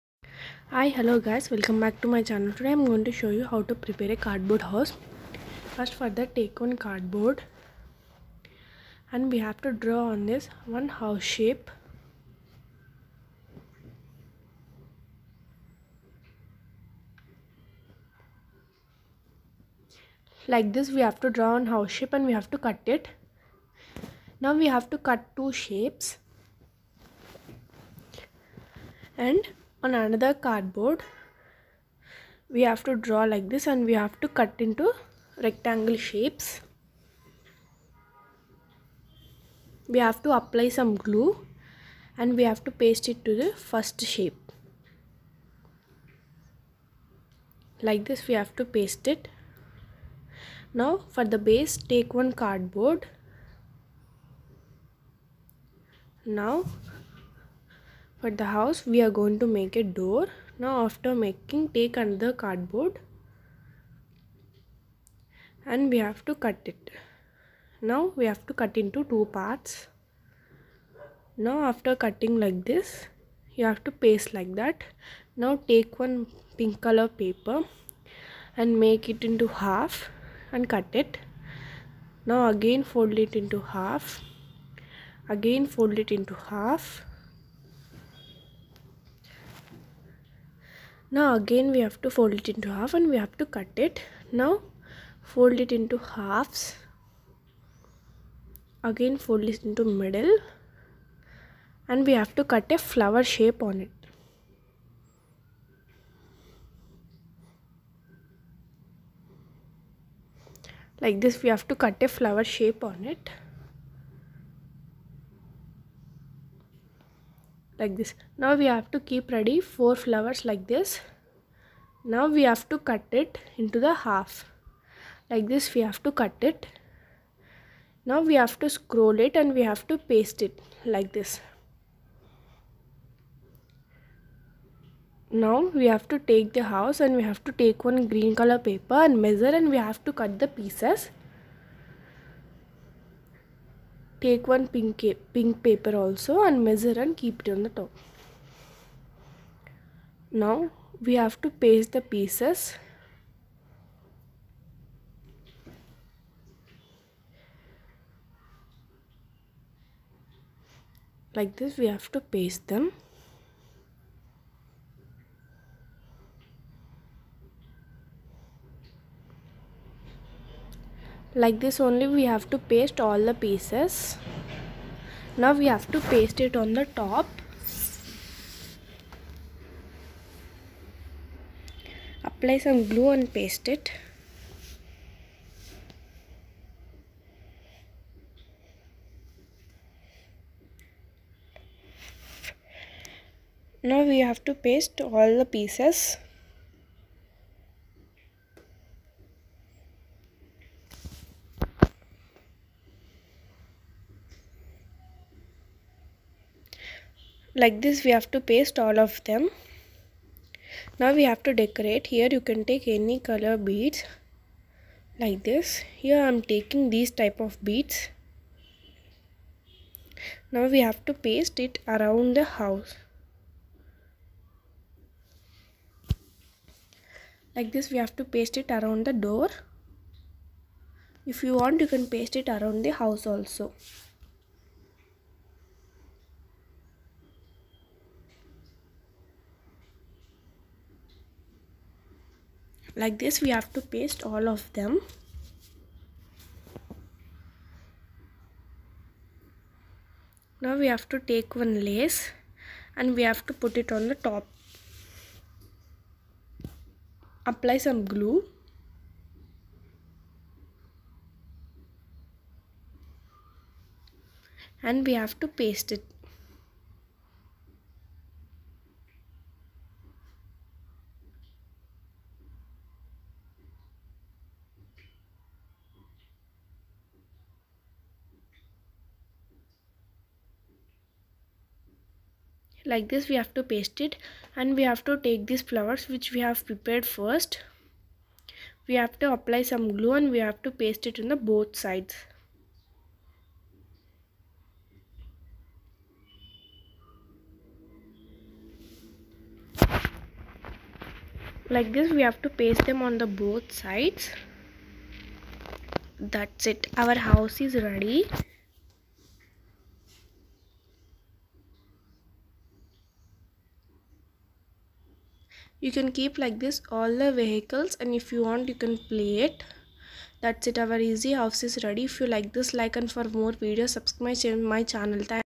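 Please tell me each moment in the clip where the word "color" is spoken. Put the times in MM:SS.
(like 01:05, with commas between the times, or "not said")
01:16, 02:18, 03:33.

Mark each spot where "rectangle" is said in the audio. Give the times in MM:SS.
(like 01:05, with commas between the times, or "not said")
00:35.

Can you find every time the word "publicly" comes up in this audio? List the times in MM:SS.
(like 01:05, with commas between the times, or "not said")
not said.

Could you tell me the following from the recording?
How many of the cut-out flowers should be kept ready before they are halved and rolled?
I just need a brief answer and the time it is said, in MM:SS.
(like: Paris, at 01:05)
4, at 01:59.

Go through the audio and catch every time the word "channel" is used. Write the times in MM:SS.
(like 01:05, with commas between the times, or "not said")
00:02, 05:24.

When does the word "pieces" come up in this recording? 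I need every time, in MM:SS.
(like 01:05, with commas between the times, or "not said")
02:20, 02:32, 02:53, 03:15.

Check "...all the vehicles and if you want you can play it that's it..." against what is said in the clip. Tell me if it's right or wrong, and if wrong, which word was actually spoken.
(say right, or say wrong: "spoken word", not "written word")
right.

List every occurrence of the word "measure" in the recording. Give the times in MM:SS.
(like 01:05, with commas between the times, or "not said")
02:19, 02:26.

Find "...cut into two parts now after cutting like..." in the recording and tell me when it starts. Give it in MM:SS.
01:08.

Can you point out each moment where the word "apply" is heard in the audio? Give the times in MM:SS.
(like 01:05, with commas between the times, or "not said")
00:40, 03:02, 04:17, 04:49.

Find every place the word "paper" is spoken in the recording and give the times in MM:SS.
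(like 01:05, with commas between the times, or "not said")
01:17, 02:18, 02:25.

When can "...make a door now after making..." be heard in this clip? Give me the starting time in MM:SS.
00:59.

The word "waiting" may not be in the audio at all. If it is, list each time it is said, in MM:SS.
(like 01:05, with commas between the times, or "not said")
not said.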